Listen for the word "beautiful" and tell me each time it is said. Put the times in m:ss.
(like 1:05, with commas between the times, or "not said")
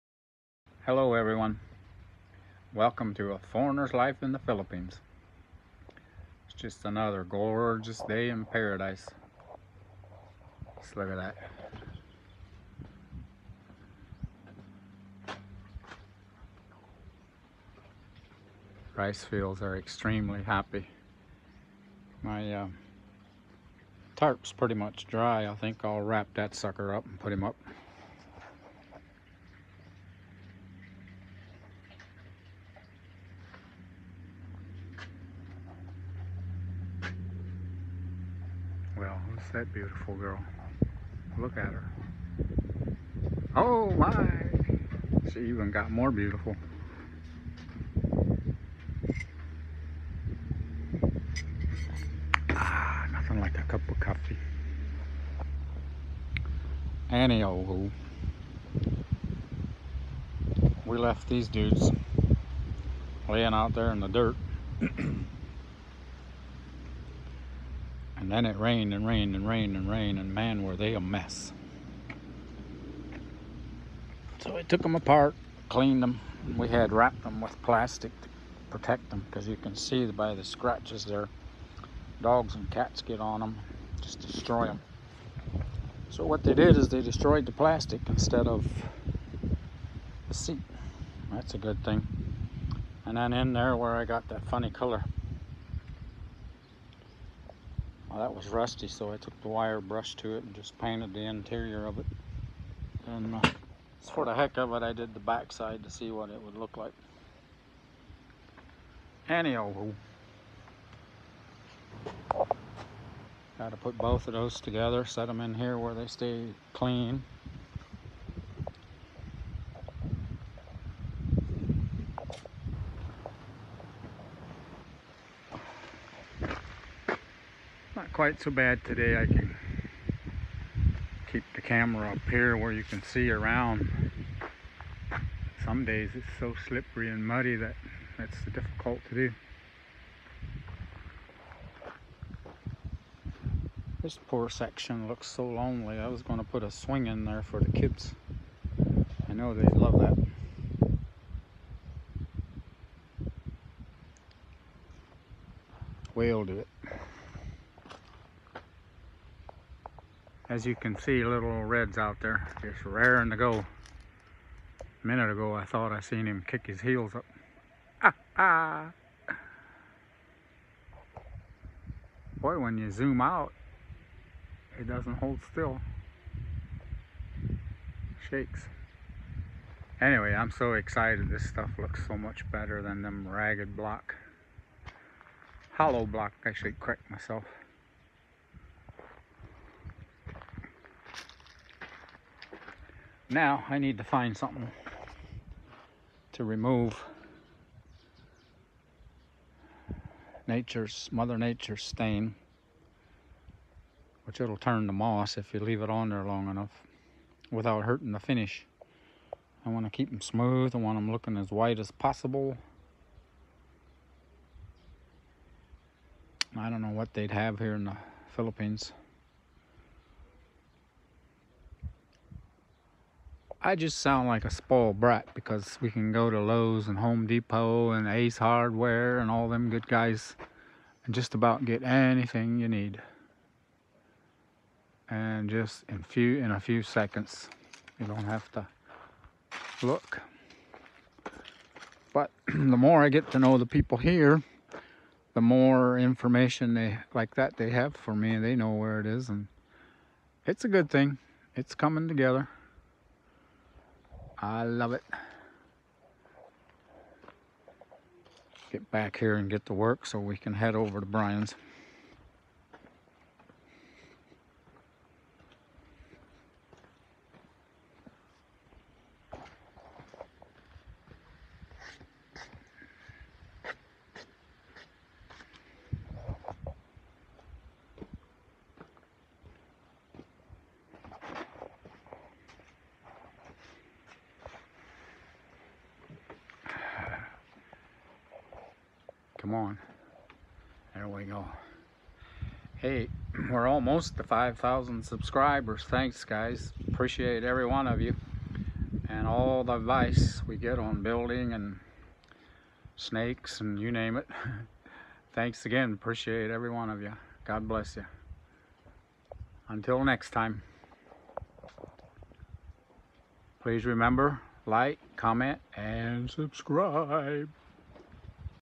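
0:39, 0:46.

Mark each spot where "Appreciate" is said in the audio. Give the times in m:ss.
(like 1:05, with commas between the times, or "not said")
4:56, 5:05.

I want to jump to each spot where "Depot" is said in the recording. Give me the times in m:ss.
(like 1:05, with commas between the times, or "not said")
3:47.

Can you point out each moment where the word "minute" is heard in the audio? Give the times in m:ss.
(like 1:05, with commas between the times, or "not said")
2:45.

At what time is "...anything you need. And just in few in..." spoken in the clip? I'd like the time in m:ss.
3:51.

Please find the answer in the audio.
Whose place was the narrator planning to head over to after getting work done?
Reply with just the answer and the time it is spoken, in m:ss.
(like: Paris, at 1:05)
Brian's, at 4:21.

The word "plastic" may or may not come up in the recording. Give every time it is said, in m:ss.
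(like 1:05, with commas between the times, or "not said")
1:17, 1:27.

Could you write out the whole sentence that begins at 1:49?
Anyhow, got to put both of those together, set them in here where they stay clean.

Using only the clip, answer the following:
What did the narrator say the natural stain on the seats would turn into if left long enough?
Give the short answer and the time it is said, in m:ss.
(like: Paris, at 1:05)
moss, at 3:24.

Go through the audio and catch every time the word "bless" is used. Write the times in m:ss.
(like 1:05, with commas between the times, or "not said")
5:07.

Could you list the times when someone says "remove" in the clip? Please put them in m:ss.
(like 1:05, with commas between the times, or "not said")
3:16.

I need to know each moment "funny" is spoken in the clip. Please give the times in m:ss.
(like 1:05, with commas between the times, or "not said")
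1:34.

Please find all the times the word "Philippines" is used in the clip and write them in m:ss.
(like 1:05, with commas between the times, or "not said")
0:04, 3:38.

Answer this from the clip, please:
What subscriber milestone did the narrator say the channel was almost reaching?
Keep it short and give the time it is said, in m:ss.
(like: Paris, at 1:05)
5,000 subscribers, at 4:54.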